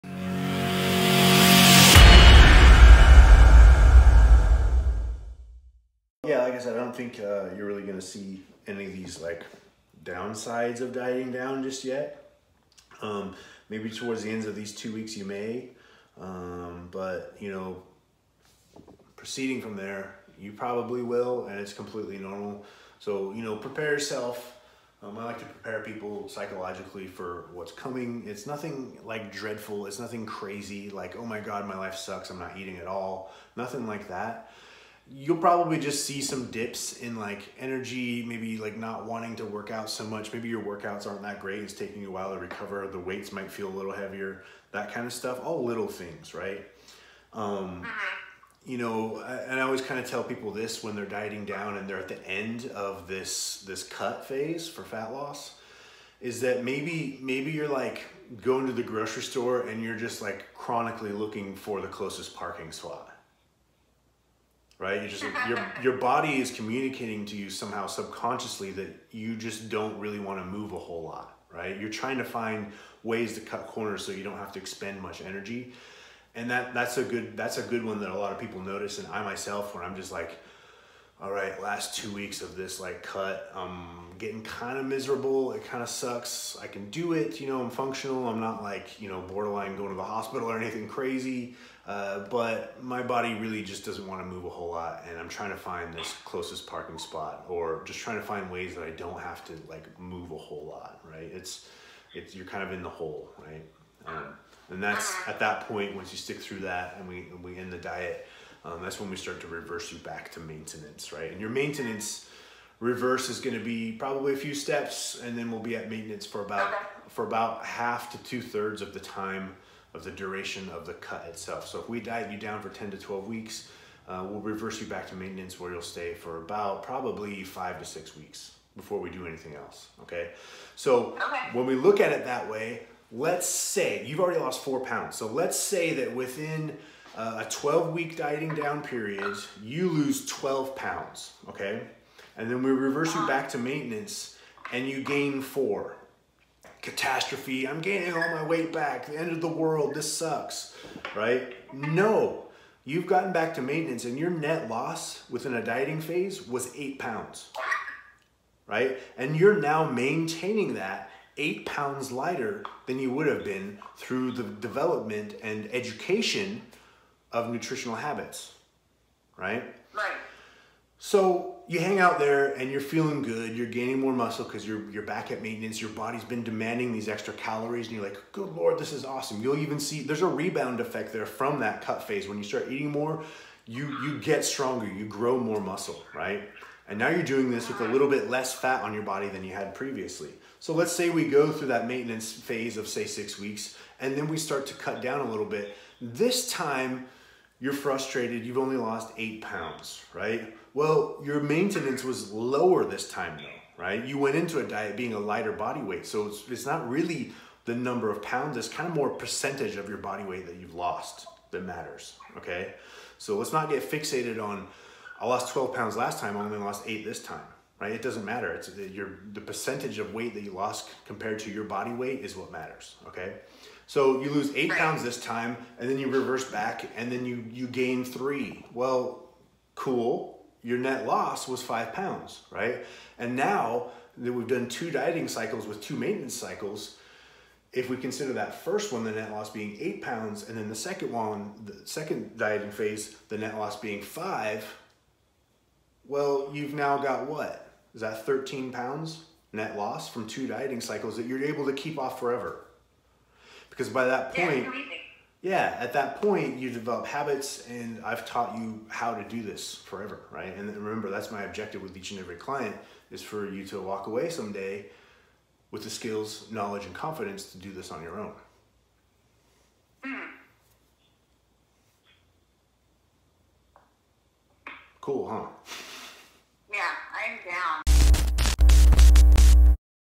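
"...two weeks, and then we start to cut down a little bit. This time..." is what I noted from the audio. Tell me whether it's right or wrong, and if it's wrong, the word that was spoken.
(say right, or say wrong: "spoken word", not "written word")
wrong: "six", not "two".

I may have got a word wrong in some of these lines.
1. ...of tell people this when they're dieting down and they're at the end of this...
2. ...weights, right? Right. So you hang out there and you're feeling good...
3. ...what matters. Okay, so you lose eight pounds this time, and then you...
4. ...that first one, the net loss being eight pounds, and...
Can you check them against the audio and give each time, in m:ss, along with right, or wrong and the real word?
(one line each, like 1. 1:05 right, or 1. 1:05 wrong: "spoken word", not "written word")
1. 0:49 right
2. 2:47 wrong: "habits", not "weights"
3. 3:42 right
4. 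3:58 right.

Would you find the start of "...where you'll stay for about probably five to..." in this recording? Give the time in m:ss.
2:05.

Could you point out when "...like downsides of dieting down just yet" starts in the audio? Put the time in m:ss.
0:09.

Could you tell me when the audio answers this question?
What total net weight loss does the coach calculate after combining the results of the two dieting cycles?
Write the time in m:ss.
4:08.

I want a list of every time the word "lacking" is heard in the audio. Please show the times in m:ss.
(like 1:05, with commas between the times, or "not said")
not said.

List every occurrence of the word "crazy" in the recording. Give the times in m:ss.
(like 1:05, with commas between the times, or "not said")
0:30, 1:30.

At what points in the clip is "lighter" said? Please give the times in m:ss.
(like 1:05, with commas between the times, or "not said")
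2:42, 3:25.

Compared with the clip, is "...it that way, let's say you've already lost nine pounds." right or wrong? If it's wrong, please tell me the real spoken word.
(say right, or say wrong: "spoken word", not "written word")
wrong: "four", not "nine".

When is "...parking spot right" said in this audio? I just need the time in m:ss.
1:02.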